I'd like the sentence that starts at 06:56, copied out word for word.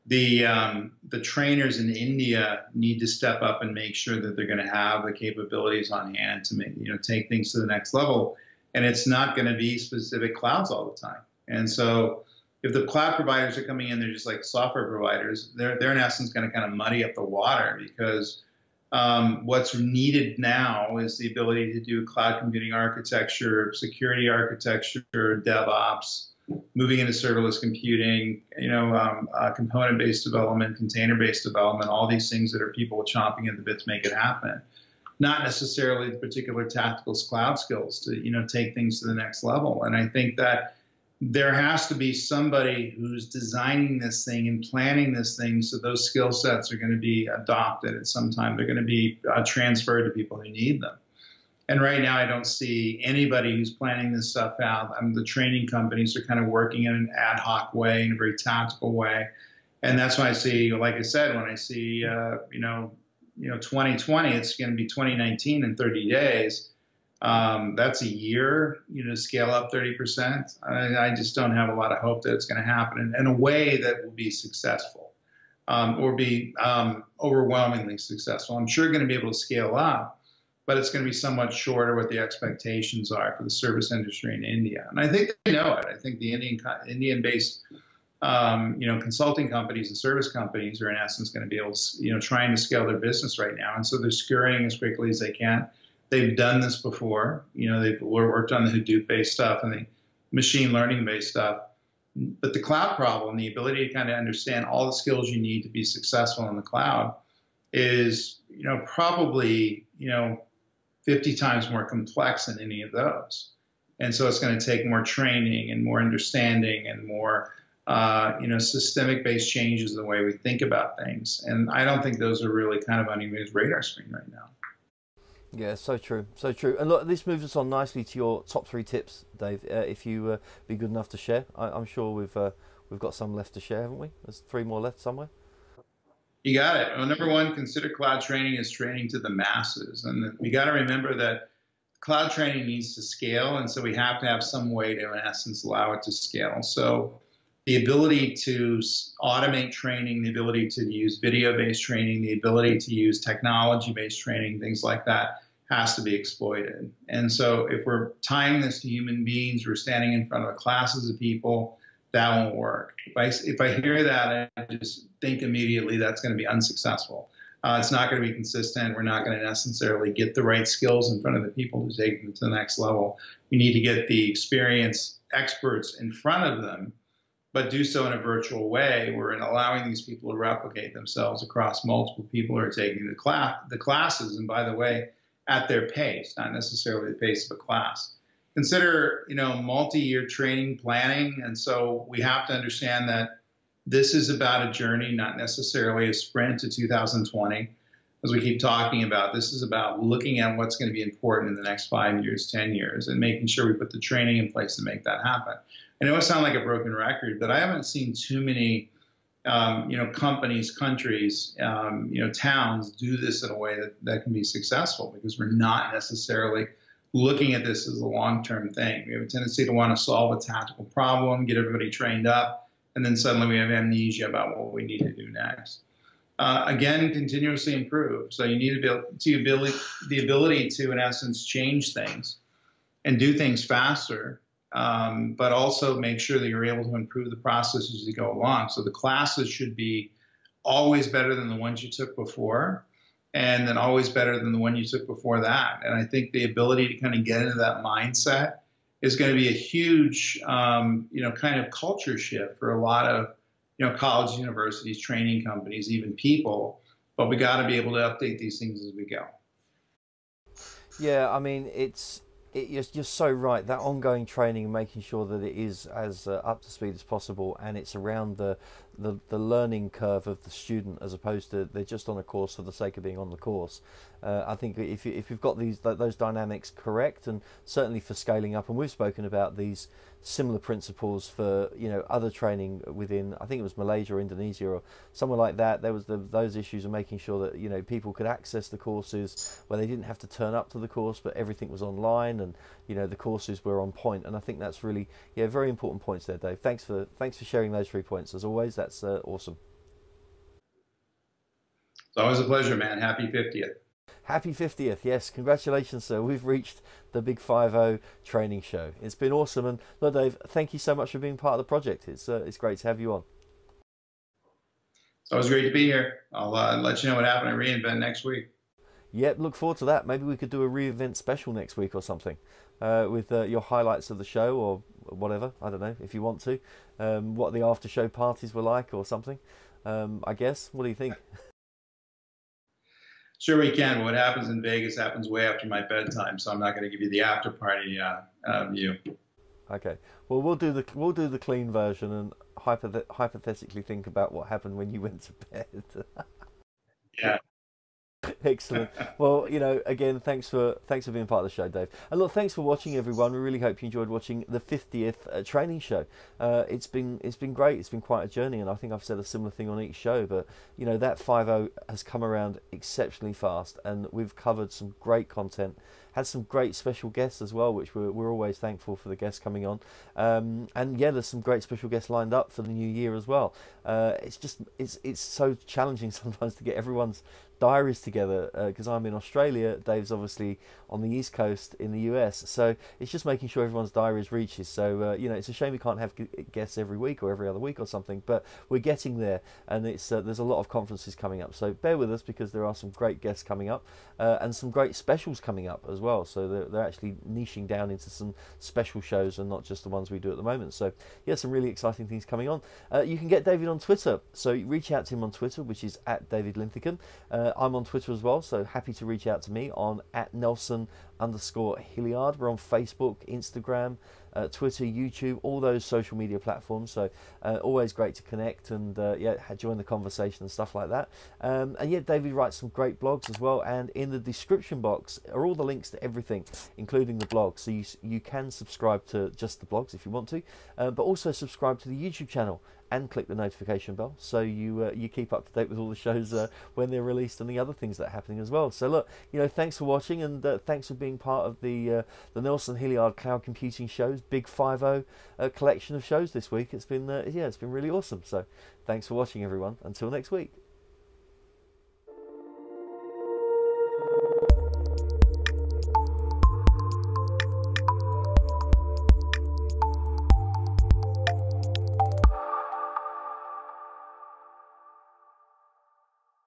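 So uh, always great to connect and uh, yeah, join the conversation and stuff like that.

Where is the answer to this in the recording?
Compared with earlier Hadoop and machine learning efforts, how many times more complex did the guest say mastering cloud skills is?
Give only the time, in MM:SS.
01:51.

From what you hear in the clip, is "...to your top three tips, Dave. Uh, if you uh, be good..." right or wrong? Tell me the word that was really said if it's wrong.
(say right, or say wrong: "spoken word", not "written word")
right.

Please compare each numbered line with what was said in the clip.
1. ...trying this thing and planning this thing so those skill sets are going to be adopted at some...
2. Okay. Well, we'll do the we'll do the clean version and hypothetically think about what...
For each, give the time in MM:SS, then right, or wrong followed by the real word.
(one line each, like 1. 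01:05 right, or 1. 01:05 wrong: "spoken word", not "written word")
1. 00:43 wrong: "designing", not "trying"
2. 05:39 right.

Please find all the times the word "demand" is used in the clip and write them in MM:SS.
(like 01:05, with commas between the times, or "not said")
not said.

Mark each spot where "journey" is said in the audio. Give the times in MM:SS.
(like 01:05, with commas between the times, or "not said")
03:14, 05:58.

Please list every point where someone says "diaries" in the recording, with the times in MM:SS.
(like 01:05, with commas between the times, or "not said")
06:17, 06:23.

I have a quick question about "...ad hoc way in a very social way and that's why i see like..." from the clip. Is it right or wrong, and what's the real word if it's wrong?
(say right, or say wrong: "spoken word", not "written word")
wrong: "tactical", not "social".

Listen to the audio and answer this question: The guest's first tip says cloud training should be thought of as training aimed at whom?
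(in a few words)
the masses.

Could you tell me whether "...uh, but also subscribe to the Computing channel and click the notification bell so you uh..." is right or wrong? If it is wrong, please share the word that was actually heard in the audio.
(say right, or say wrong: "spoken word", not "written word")
wrong: "YouTube", not "Computing".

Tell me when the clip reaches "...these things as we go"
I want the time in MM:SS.
04:18.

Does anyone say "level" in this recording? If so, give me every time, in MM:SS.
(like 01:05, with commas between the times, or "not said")
00:07, 00:39, 02:52.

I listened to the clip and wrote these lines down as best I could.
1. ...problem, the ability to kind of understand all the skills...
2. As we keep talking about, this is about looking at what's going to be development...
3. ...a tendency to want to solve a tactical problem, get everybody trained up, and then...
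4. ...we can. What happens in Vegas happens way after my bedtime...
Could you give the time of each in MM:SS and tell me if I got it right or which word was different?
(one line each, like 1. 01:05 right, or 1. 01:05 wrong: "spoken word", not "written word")
1. 01:42 right
2. 03:18 wrong: "important", not "development"
3. 03:39 right
4. 05:33 right.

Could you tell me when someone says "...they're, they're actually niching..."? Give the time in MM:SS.
06:36.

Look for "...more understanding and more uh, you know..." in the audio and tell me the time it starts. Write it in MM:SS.
01:55.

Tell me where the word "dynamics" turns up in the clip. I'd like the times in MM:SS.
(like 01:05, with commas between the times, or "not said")
04:36.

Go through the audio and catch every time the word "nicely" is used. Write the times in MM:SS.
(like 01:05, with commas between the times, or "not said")
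02:07.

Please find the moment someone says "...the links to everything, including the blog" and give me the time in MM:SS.
07:05.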